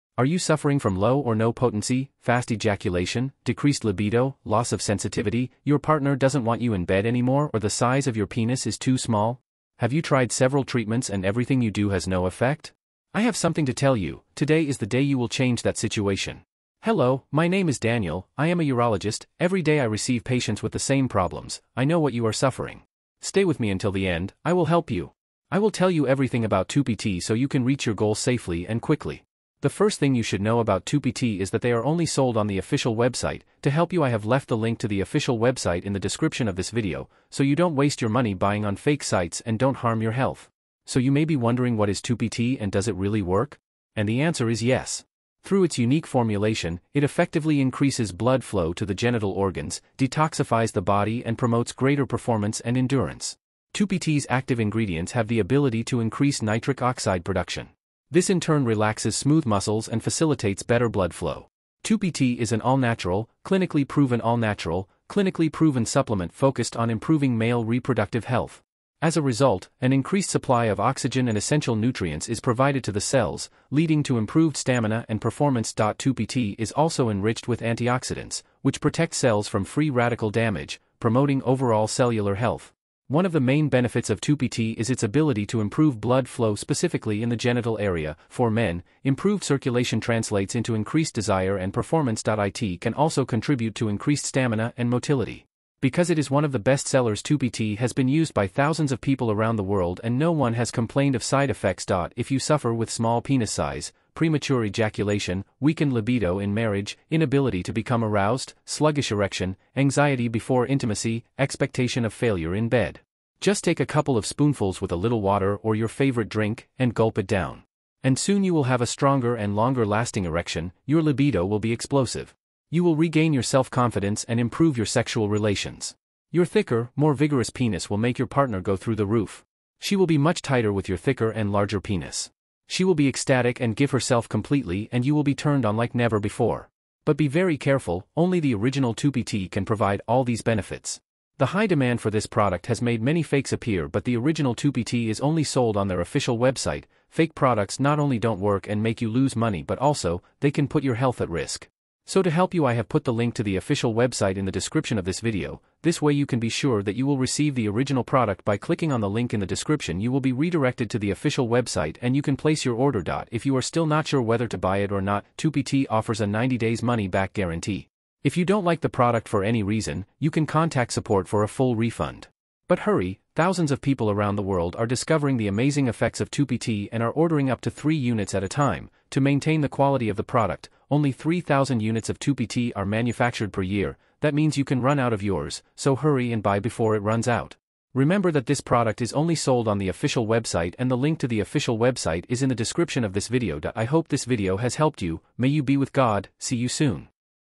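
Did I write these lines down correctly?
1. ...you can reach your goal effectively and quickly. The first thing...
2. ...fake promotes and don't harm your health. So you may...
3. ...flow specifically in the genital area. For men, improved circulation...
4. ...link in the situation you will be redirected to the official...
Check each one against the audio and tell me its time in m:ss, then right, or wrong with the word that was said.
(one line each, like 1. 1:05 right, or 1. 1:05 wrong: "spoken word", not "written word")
1. 0:27 wrong: "safely", not "effectively"
2. 0:38 wrong: "sites", not "promotes"
3. 1:26 right
4. 2:39 wrong: "description", not "situation".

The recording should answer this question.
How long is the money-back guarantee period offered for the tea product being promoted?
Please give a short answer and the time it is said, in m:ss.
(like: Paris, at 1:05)
90 days, at 2:46.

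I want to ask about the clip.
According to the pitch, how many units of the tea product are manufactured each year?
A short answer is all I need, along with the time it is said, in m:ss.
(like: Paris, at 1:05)
3,000, at 3:01.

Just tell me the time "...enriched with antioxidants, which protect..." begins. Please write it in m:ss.
1:17.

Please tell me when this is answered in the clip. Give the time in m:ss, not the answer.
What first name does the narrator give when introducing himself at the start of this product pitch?
0:17.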